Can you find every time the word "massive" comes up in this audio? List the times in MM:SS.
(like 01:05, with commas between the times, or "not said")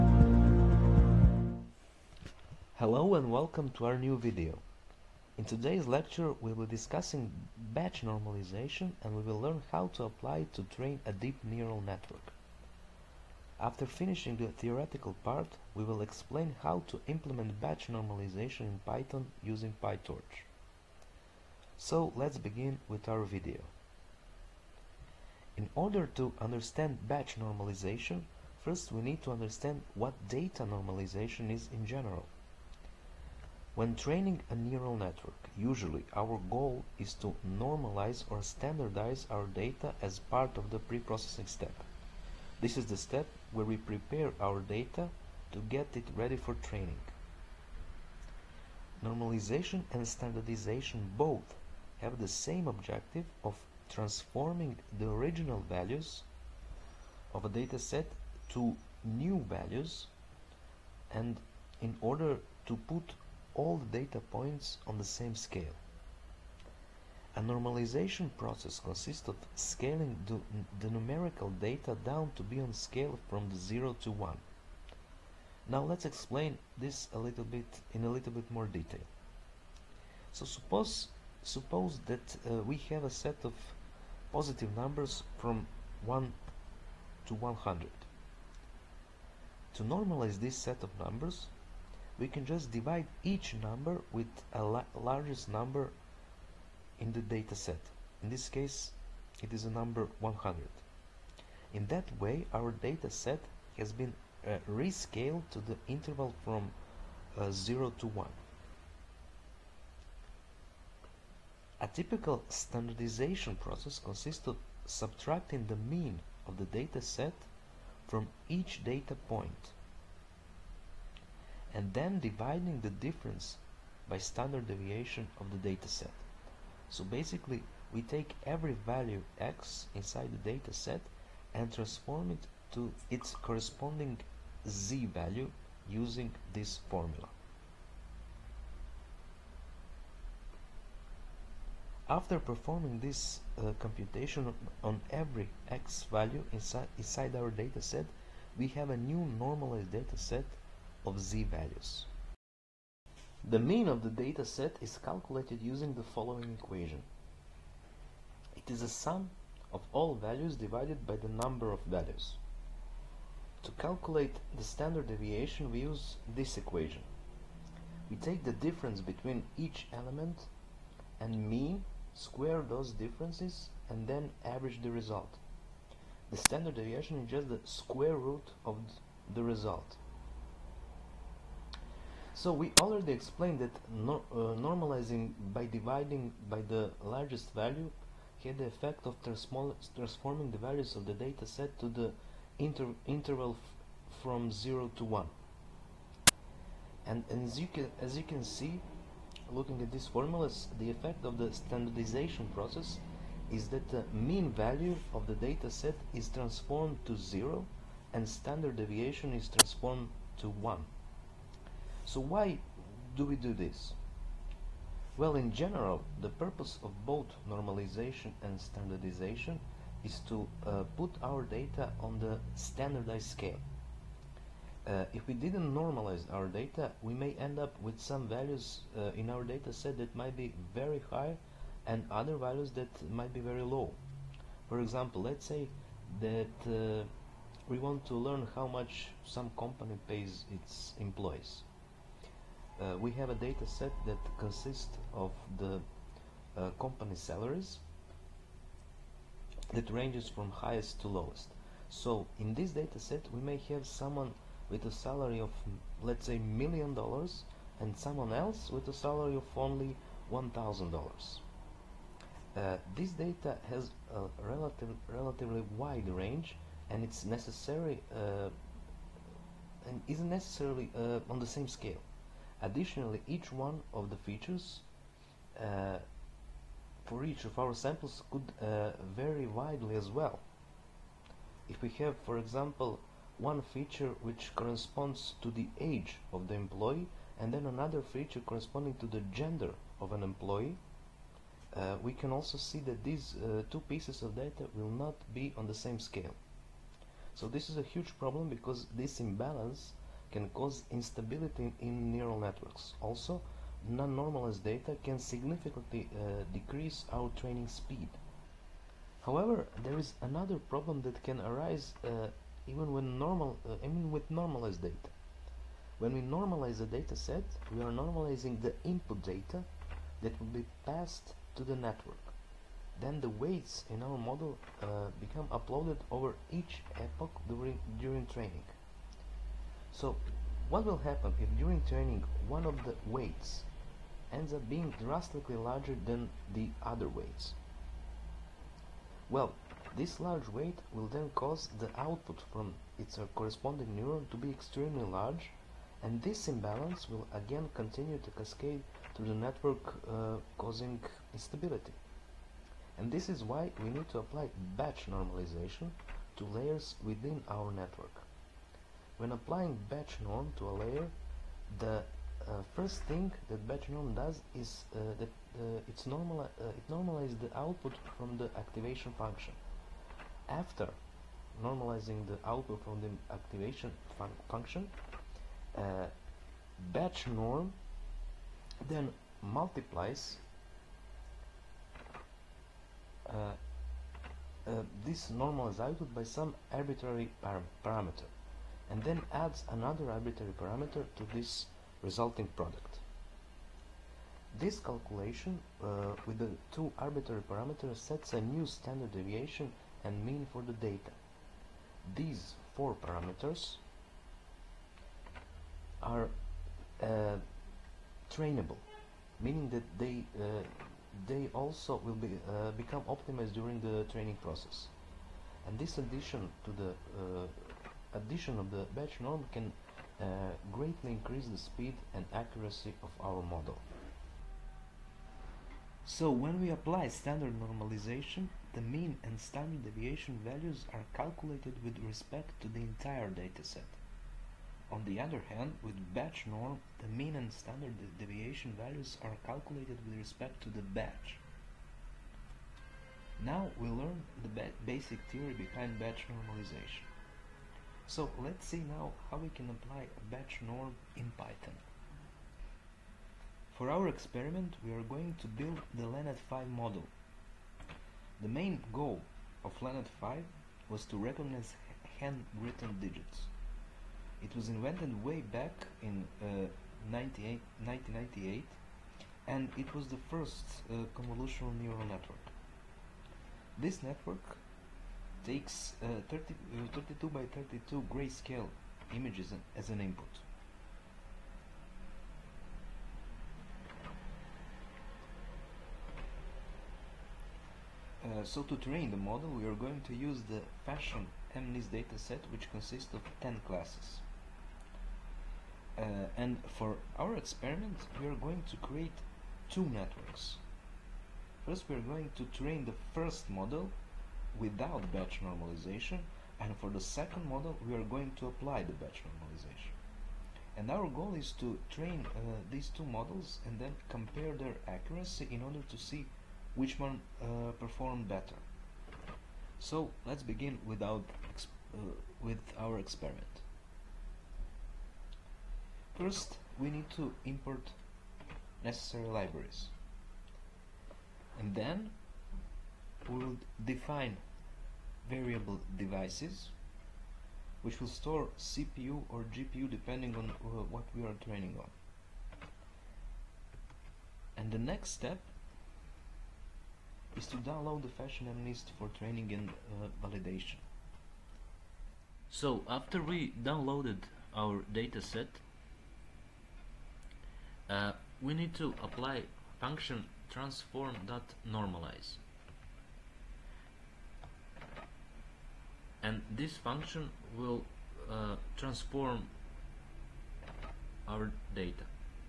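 not said.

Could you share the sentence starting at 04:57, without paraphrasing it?
So this is a huge problem because this imbalance can cause instability in neural networks.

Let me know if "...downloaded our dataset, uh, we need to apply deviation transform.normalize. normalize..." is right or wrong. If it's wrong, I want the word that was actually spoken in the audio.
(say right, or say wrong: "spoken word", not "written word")
wrong: "function", not "deviation".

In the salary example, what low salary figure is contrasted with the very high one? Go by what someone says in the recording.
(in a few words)
$1,000.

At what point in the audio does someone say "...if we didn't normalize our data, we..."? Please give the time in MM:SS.
03:45.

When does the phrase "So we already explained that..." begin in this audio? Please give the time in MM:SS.
03:02.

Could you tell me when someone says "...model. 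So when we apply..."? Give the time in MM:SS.
07:03.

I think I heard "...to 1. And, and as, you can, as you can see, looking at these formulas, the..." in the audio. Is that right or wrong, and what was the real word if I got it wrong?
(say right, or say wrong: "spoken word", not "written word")
right.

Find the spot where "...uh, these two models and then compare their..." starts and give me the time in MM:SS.
08:32.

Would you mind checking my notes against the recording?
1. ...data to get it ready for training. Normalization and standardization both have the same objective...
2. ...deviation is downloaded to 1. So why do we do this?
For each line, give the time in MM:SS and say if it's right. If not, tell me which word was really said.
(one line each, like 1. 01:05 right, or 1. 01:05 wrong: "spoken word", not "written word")
1. 00:44 right
2. 03:28 wrong: "transformed", not "downloaded".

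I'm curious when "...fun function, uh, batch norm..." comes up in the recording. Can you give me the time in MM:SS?
06:14.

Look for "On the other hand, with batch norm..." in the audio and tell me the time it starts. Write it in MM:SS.
07:14.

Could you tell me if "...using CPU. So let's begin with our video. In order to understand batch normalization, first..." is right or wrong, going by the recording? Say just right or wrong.
wrong.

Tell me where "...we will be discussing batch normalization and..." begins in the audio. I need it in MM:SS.
00:06.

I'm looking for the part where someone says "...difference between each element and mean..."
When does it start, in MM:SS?
02:48.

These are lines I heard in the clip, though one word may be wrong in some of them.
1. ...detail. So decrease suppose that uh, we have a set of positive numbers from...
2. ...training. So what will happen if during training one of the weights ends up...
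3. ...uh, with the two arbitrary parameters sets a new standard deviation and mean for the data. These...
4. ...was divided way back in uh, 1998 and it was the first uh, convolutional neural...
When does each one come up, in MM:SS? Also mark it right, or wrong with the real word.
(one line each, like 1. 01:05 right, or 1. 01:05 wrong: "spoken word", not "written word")
1. 01:18 wrong: "suppose", not "decrease"
2. 05:28 right
3. 06:35 right
4. 07:44 wrong: "invented", not "divided".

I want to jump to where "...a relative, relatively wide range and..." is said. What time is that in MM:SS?
04:24.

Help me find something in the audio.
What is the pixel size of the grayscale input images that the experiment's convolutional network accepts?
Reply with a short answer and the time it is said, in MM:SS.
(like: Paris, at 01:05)
32 by 32, at 07:56.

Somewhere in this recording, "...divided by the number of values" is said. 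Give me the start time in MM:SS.
02:40.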